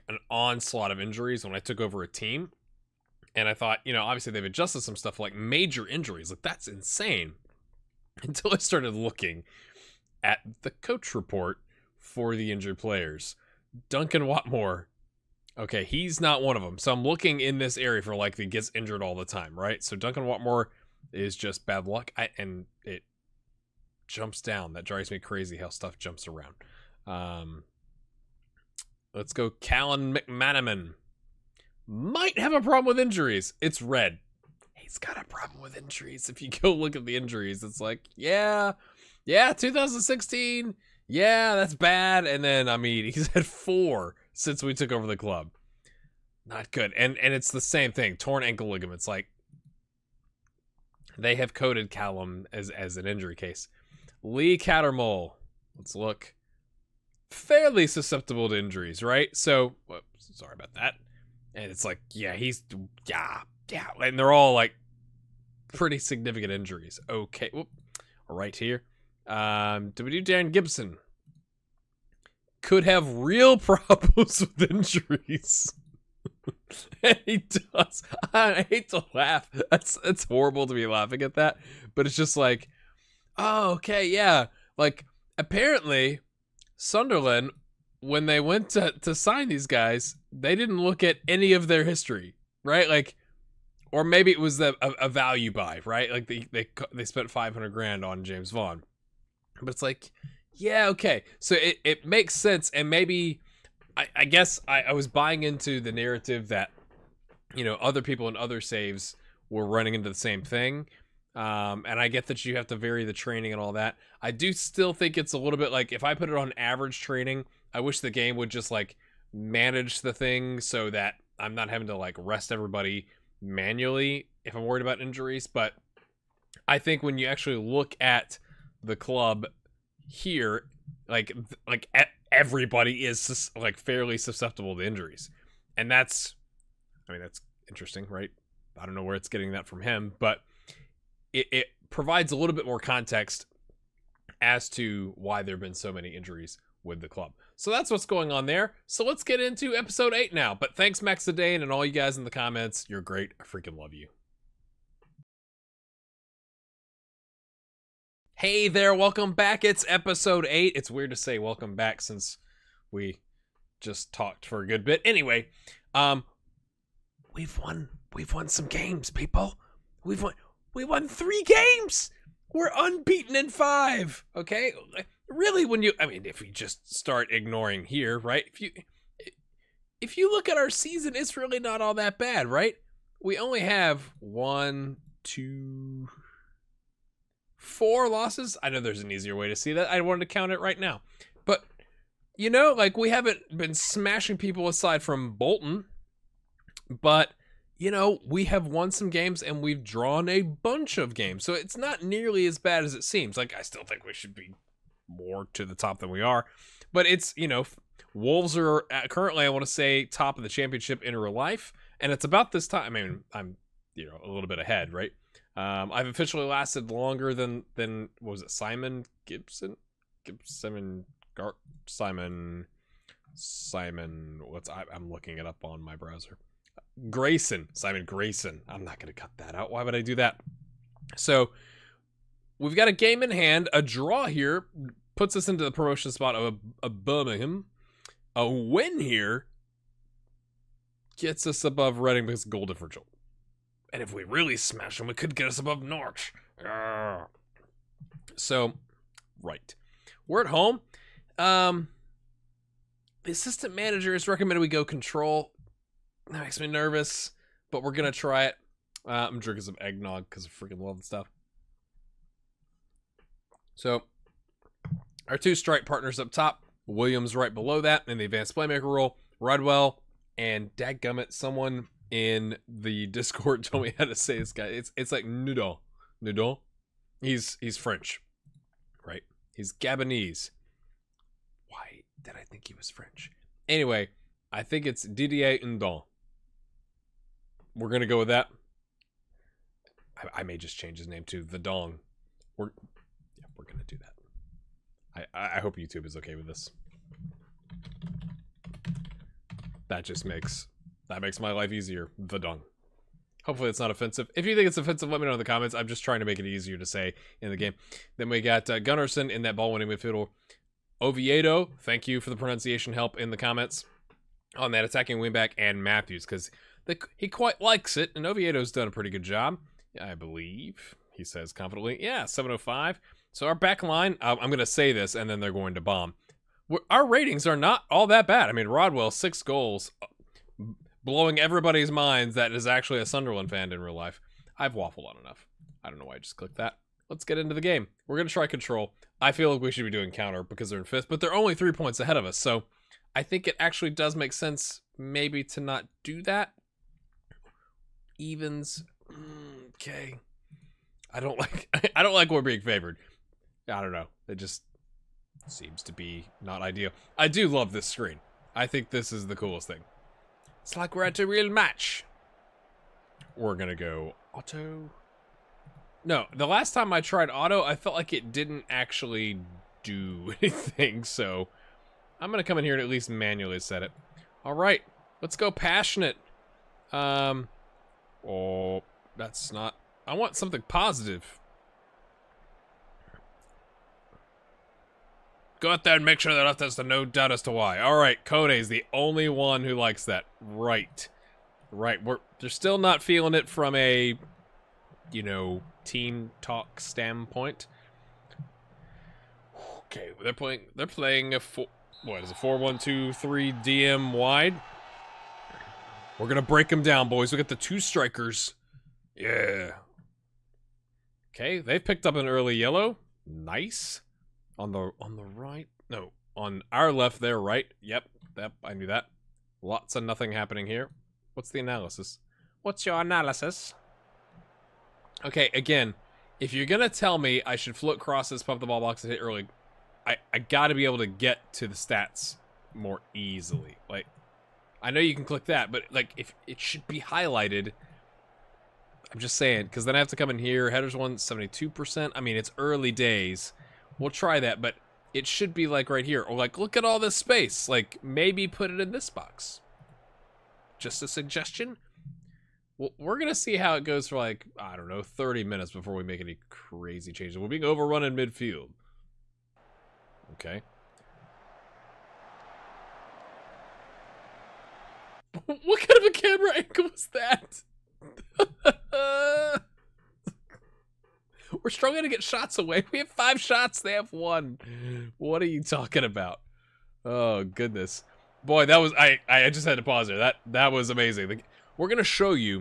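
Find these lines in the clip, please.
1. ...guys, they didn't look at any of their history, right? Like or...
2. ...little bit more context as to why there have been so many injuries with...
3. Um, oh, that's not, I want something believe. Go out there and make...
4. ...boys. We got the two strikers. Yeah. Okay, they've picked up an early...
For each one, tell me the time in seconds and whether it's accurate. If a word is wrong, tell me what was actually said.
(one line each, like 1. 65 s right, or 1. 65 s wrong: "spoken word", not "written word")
1. 89 s right
2. 142 s right
3. 376 s wrong: "positive", not "believe"
4. 407 s right.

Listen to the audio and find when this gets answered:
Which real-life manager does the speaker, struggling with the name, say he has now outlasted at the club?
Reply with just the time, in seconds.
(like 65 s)
227 s.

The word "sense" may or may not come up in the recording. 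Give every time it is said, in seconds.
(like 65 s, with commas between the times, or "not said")
102 s, 344 s.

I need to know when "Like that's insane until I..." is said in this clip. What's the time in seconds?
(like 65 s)
6 s.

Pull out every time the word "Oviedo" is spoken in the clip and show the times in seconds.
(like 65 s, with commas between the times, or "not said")
311 s, 318 s.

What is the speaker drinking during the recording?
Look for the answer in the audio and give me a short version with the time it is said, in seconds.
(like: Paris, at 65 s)
Eggnog, at 259 s.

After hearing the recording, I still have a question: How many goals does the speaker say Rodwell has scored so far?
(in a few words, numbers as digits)
6.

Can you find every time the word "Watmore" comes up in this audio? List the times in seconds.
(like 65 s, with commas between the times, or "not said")
14 s, 20 s.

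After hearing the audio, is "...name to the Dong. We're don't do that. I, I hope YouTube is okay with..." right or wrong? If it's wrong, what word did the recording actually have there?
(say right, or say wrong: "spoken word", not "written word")
right.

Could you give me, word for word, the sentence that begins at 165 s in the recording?
Anyway, um we've won we've won some games, people.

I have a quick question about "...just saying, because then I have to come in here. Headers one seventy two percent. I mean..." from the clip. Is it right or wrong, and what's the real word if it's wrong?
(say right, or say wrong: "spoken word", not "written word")
right.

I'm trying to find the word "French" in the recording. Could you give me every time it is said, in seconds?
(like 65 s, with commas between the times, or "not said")
277 s, 282 s.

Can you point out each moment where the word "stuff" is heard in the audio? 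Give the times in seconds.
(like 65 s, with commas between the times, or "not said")
4 s, 25 s, 261 s.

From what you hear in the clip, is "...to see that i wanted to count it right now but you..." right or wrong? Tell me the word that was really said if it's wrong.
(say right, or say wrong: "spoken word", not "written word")
right.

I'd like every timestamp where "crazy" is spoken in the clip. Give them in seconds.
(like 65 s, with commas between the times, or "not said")
25 s, 456 s.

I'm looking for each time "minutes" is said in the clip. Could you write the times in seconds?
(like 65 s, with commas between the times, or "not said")
455 s.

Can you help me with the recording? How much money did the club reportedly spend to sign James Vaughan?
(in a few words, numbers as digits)
500 grand.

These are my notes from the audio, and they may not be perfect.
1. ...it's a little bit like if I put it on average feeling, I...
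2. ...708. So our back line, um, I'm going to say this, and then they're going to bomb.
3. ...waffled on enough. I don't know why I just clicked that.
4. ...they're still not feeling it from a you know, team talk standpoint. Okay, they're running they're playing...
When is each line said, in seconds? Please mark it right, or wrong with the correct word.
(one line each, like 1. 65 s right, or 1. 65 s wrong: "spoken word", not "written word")
1. 115 s wrong: "training", not "feeling"
2. 322 s wrong: "705", not "708"
3. 334 s right
4. 392 s wrong: "playing", not "running".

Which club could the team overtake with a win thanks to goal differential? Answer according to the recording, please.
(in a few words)
Reading.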